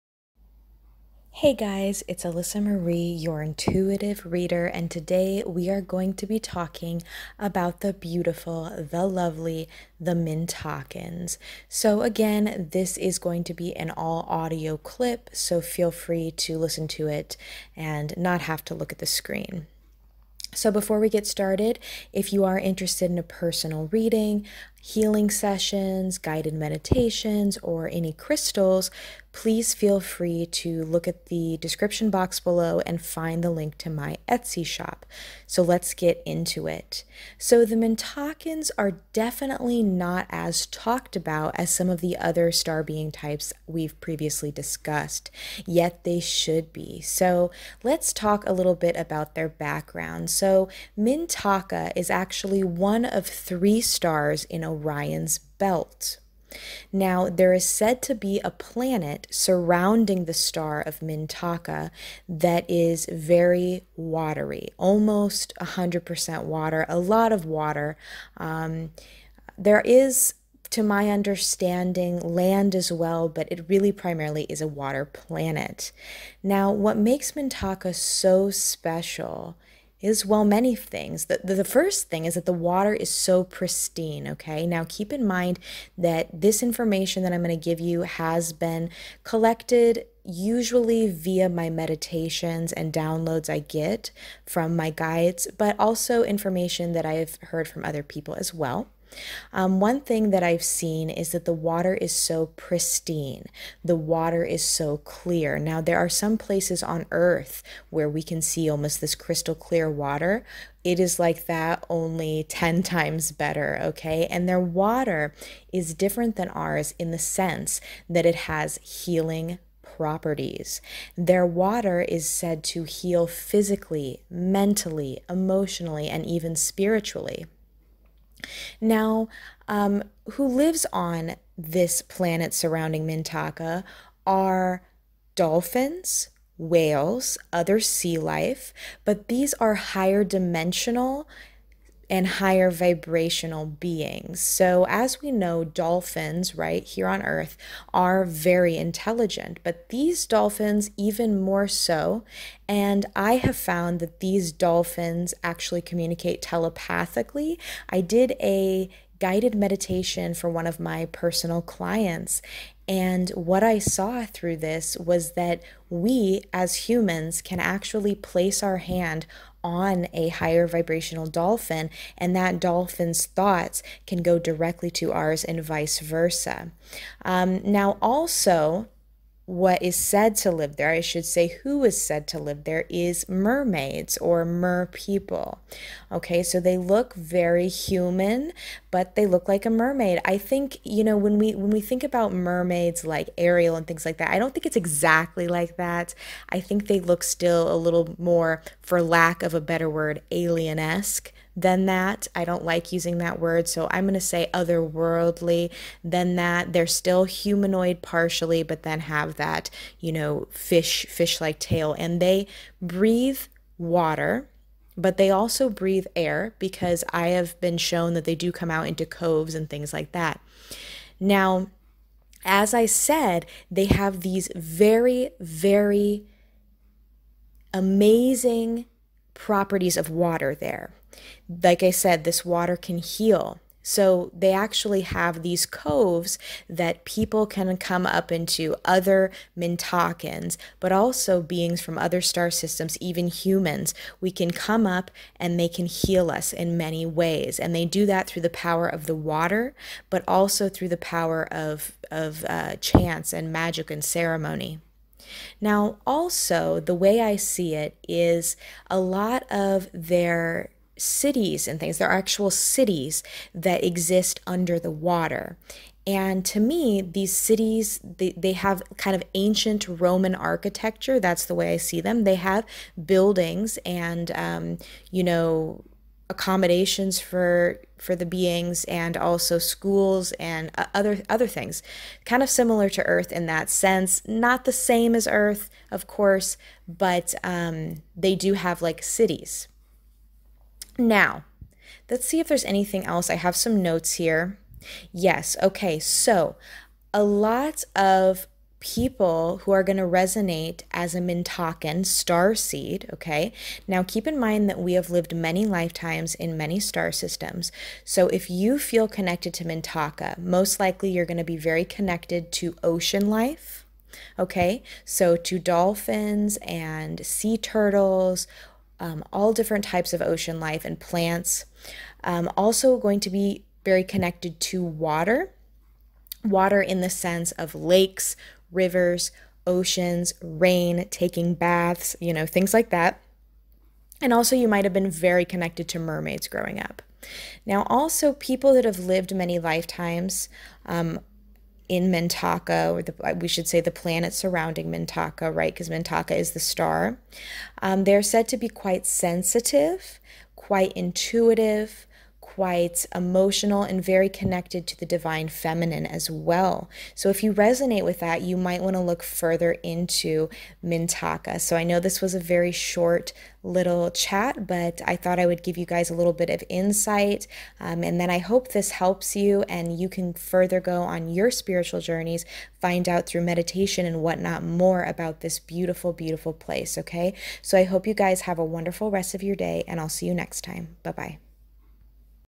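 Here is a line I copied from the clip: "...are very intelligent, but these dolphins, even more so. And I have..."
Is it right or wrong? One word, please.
right.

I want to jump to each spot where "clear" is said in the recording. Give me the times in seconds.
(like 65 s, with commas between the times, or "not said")
104 s, 109 s.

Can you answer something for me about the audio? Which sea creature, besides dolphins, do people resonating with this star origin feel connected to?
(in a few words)
Sea turtles.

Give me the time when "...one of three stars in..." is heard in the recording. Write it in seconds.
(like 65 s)
52 s.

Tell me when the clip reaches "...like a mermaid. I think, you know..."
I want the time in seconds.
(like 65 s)
189 s.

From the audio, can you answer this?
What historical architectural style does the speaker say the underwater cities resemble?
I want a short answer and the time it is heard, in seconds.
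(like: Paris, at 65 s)
Ancient Roman, at 269 s.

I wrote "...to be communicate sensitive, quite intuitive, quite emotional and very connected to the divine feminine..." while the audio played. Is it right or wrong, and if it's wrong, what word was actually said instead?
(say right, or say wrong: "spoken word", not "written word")
wrong: "quite", not "communicate".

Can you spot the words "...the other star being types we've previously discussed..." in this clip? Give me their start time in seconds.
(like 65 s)
42 s.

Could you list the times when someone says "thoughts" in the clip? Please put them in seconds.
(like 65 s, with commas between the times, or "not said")
173 s, 365 s.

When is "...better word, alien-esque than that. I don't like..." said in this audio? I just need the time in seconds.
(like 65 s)
199 s.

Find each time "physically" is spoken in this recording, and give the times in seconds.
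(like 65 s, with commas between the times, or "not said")
123 s.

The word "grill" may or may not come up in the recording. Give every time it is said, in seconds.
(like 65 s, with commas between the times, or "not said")
not said.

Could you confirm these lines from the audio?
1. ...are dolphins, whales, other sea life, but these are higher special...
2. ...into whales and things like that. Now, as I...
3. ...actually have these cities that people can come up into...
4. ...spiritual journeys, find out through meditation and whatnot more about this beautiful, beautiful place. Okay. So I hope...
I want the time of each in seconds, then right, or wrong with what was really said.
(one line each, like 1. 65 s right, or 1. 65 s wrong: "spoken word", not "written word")
1. 134 s wrong: "dimensional", not "special"
2. 218 s wrong: "coves", not "whales"
3. 234 s wrong: "coves", not "cities"
4. 371 s right.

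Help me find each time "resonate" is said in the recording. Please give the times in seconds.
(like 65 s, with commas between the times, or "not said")
300 s, 357 s.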